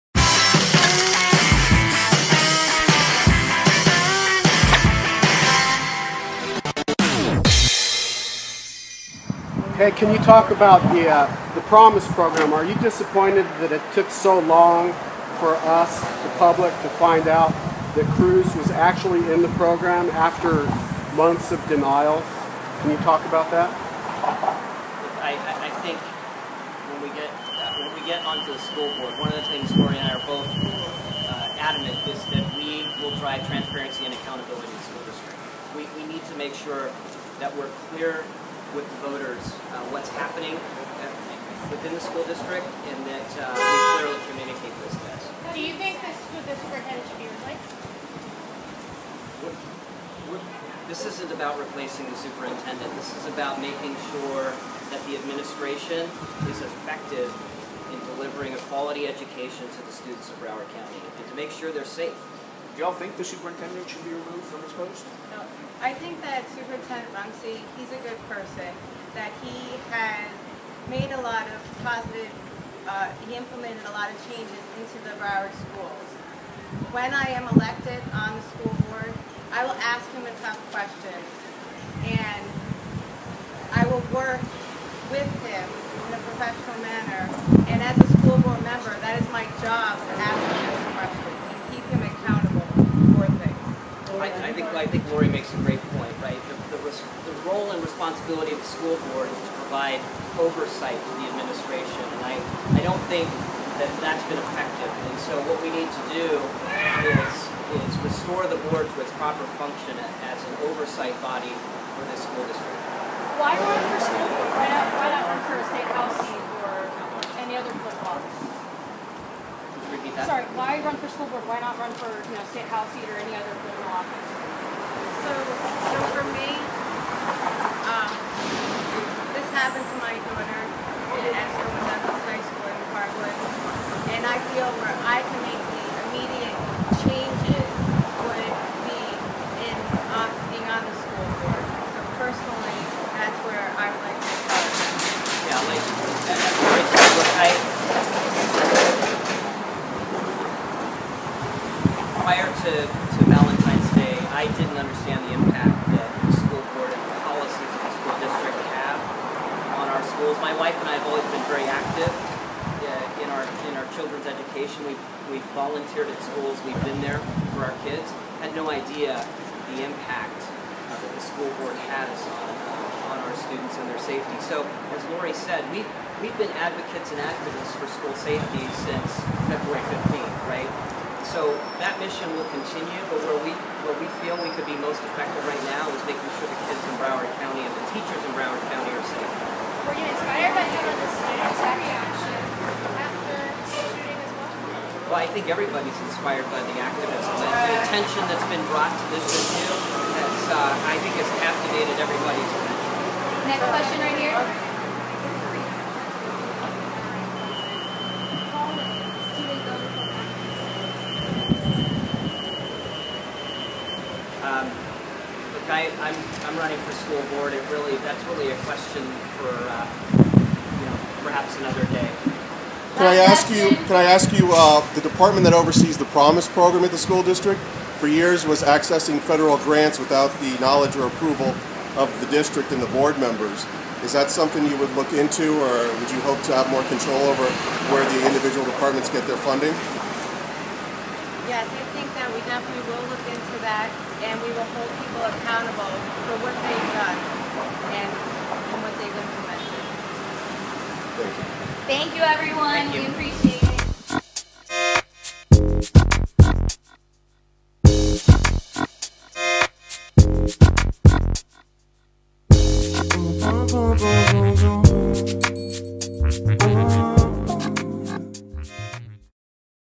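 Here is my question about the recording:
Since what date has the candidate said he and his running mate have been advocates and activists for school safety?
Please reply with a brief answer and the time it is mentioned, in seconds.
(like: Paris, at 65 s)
February 15th, at 179 s.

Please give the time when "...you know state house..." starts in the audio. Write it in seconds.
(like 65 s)
122 s.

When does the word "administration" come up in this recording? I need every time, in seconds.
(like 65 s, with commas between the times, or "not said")
55 s, 101 s.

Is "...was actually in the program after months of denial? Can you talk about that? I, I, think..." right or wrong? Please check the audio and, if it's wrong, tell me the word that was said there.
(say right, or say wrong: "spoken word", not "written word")
right.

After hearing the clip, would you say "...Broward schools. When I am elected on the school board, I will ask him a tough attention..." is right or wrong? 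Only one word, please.
wrong.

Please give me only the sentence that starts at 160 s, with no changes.
My wife and I have always been very active uh, in our in our children's education.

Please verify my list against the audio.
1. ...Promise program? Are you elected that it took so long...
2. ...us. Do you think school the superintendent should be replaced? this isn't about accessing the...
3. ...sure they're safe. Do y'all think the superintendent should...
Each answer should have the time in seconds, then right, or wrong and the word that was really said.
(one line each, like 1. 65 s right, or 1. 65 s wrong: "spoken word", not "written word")
1. 11 s wrong: "disappointed", not "elected"
2. 45 s wrong: "replacing", not "accessing"
3. 61 s right.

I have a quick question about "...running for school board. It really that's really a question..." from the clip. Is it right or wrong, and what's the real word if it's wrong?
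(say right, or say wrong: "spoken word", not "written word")
right.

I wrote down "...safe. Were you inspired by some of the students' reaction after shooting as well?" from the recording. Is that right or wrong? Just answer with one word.
right.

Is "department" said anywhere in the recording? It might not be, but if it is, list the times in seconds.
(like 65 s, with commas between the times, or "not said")
225 s, 238 s.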